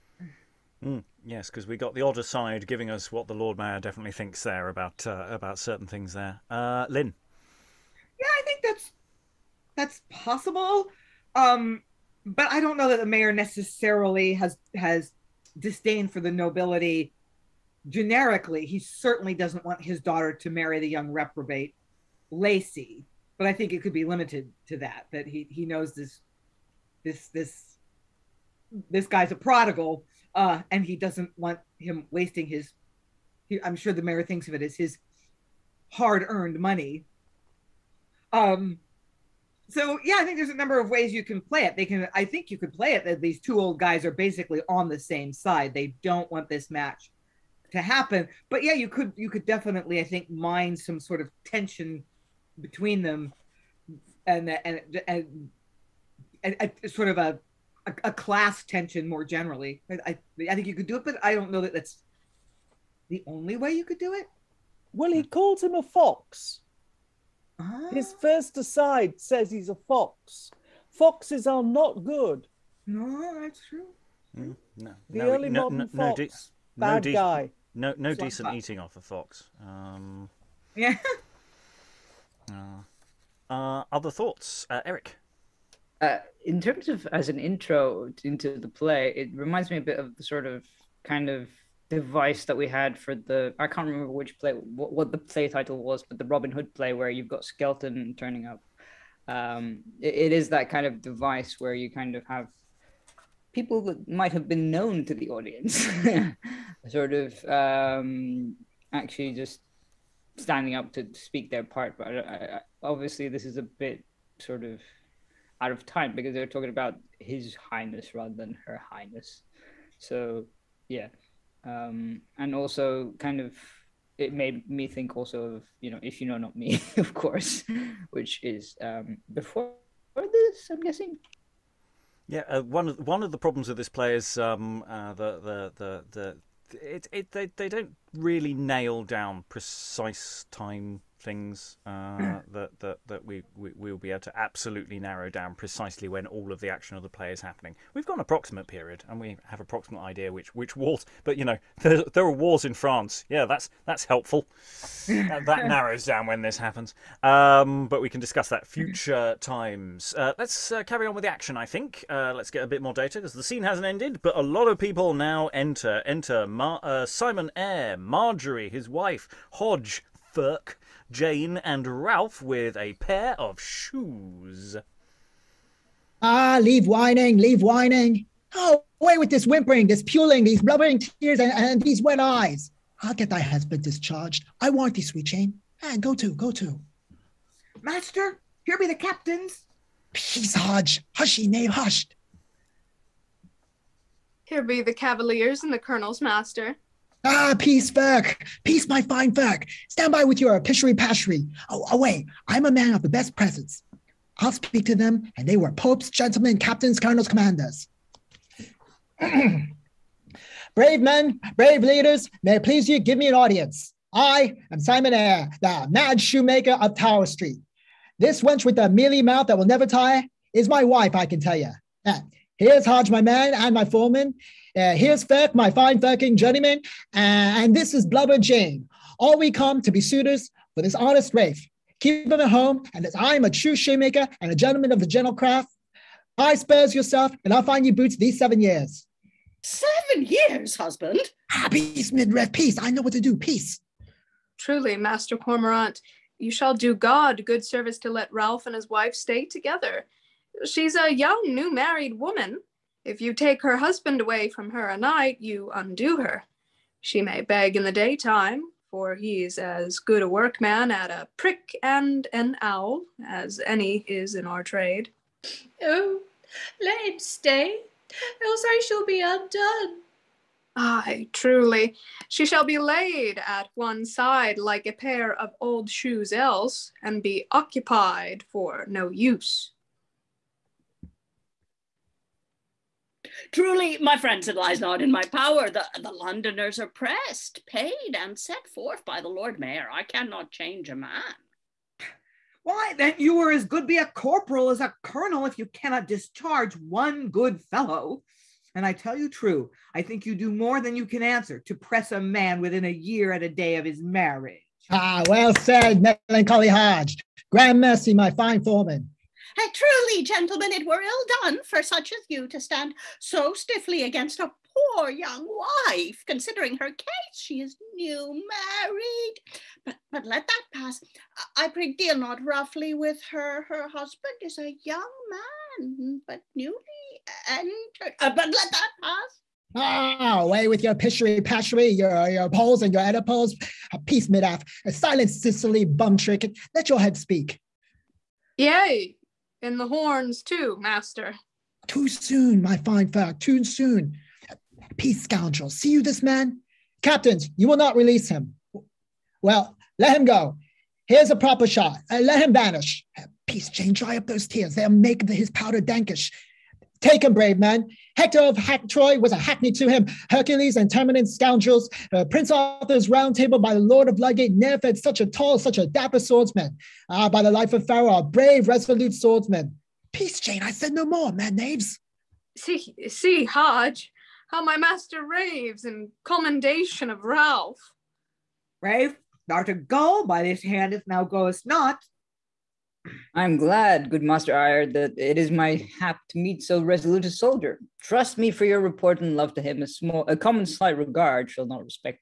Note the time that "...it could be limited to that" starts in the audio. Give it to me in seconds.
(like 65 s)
23 s.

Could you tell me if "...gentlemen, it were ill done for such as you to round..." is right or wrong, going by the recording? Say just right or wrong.
wrong.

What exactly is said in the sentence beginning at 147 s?
We've got an approximate period, and we have approximate idea which which wars.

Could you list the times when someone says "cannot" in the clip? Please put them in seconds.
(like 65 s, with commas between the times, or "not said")
290 s, 295 s.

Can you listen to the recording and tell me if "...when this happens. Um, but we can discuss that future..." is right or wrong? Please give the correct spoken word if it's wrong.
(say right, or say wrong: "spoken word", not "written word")
right.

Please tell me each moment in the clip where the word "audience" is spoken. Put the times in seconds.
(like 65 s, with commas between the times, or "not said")
105 s, 213 s.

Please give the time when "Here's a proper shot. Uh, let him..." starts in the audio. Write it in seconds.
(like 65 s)
351 s.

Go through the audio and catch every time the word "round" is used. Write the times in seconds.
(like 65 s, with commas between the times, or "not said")
363 s.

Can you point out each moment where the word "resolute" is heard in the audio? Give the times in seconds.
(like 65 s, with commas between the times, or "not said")
368 s, 386 s.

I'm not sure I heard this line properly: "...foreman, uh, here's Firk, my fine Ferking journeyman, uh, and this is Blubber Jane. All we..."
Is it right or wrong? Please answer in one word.
right.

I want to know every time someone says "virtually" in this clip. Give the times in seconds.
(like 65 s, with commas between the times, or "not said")
not said.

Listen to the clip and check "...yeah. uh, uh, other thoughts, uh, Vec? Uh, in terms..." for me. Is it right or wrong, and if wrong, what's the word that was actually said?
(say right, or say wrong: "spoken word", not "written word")
wrong: "Eric", not "Vec".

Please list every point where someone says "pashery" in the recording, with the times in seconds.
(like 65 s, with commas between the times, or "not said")
200 s, 331 s.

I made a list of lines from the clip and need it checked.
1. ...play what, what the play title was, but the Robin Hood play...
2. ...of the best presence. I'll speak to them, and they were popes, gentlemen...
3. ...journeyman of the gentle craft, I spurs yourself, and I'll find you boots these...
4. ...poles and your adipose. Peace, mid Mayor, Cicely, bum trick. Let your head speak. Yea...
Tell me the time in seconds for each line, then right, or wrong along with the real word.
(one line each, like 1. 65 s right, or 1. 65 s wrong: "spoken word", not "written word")
1. 94 s right
2. 202 s right
3. 234 s wrong: "gentleman", not "journeyman"
4. 332 s wrong: "Silence", not "Mayor".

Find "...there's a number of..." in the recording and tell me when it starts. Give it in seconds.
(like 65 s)
40 s.